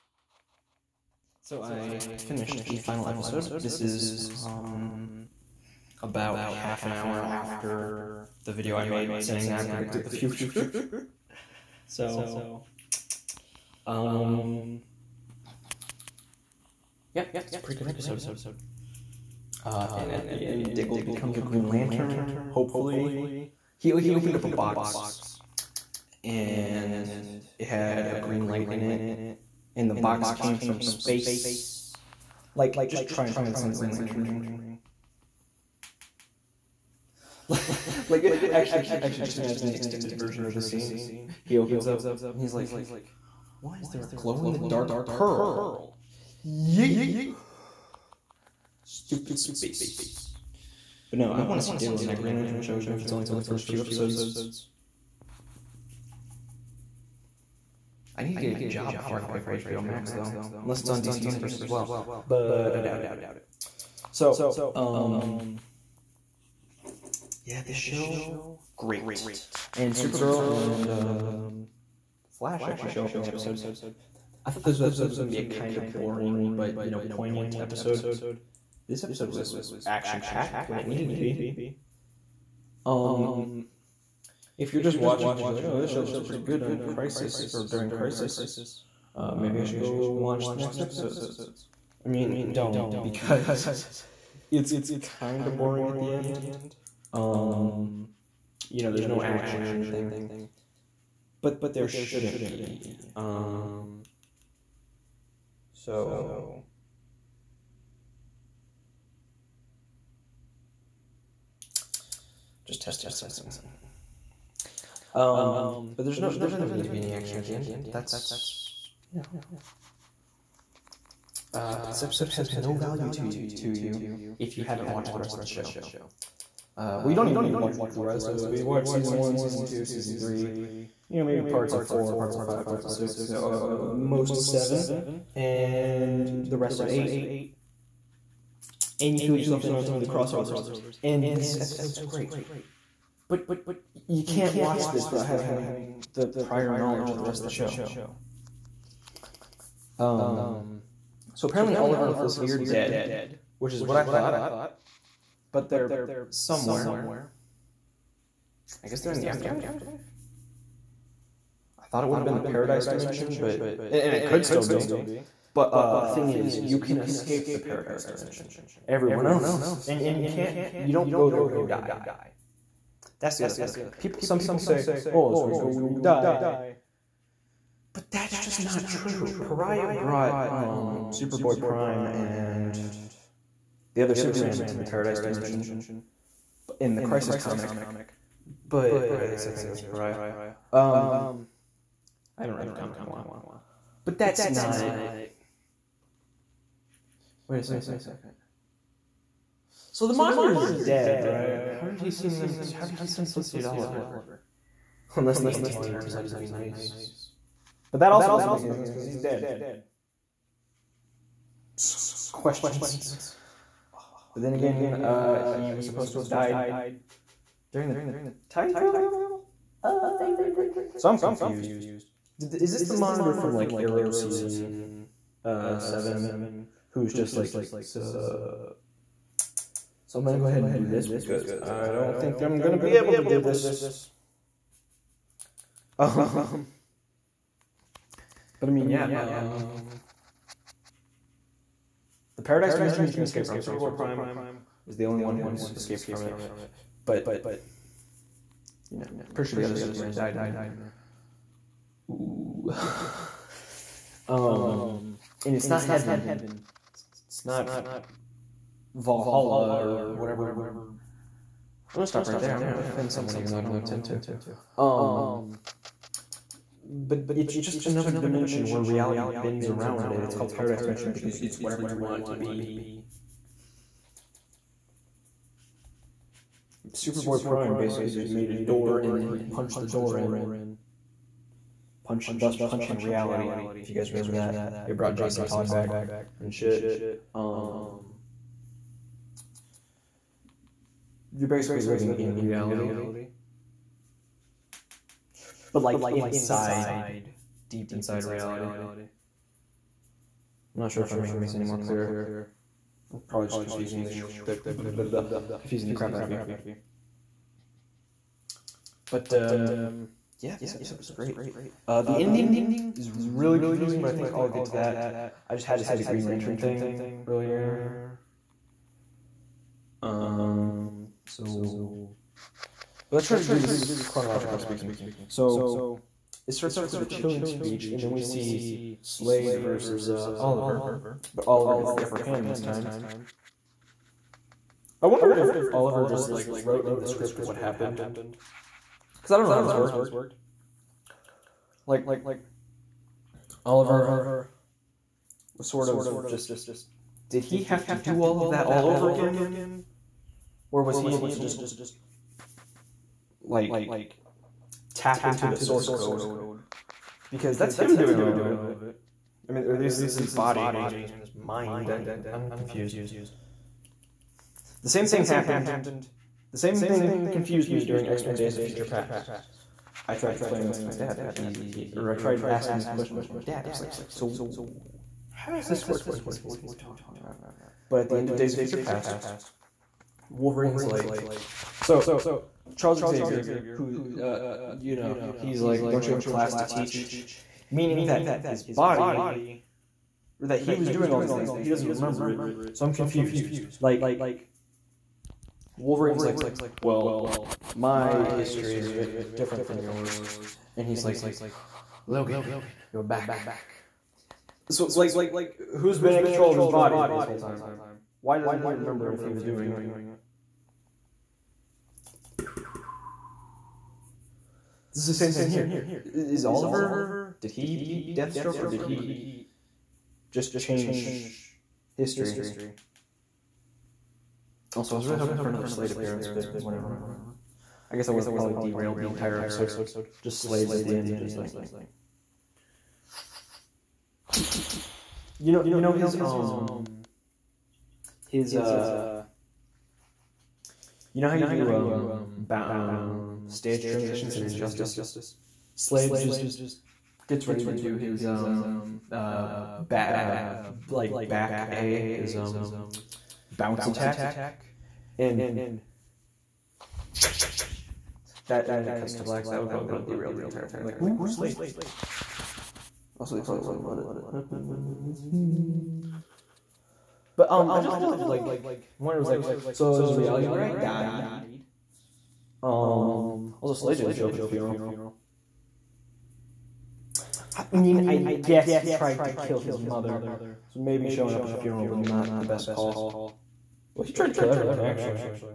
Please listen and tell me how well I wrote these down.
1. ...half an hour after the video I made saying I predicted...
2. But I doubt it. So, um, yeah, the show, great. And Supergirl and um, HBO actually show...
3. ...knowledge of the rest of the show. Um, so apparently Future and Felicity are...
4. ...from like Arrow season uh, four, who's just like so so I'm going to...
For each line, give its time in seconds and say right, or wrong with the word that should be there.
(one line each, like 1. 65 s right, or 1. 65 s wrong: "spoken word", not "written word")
1. 6 s right
2. 62 s wrong: "Flash", not "HBO"
3. 146 s wrong: "Oliver", not "Future"
4. 223 s wrong: "seven", not "four".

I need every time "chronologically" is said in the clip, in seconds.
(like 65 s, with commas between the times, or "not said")
324 s.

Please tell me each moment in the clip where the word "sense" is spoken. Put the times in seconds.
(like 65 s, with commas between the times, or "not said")
208 s.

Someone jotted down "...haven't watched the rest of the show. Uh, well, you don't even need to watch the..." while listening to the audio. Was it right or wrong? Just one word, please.
right.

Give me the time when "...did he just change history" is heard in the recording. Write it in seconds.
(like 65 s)
418 s.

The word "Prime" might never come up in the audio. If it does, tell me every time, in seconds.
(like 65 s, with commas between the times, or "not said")
181 s, 243 s, 277 s.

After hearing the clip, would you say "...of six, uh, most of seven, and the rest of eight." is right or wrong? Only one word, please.
right.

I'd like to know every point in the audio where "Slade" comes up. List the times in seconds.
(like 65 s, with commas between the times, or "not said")
329 s, 425 s, 430 s, 445 s, 461 s, 473 s.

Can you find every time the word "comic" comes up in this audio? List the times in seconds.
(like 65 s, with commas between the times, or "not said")
187 s, 192 s.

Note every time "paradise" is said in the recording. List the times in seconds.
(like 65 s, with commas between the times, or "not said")
162 s, 167 s, 184 s, 242 s, 270 s.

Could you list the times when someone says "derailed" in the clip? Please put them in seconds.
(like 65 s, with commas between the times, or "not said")
428 s, 460 s.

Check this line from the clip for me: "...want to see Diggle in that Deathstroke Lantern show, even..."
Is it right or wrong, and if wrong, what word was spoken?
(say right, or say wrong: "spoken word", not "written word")
wrong: "Green", not "Deathstroke".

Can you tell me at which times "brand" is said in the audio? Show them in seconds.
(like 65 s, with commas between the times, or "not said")
not said.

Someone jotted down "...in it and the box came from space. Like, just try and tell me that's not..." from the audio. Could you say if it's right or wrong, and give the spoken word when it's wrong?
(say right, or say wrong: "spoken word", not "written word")
right.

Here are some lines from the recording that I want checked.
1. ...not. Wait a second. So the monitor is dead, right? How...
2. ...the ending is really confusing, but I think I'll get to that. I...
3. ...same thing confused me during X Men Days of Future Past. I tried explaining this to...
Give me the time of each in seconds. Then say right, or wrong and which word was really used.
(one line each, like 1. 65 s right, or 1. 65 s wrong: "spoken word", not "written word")
1. 194 s right
2. 312 s right
3. 366 s right.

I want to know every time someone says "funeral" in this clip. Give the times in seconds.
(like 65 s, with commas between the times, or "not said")
474 s, 481 s.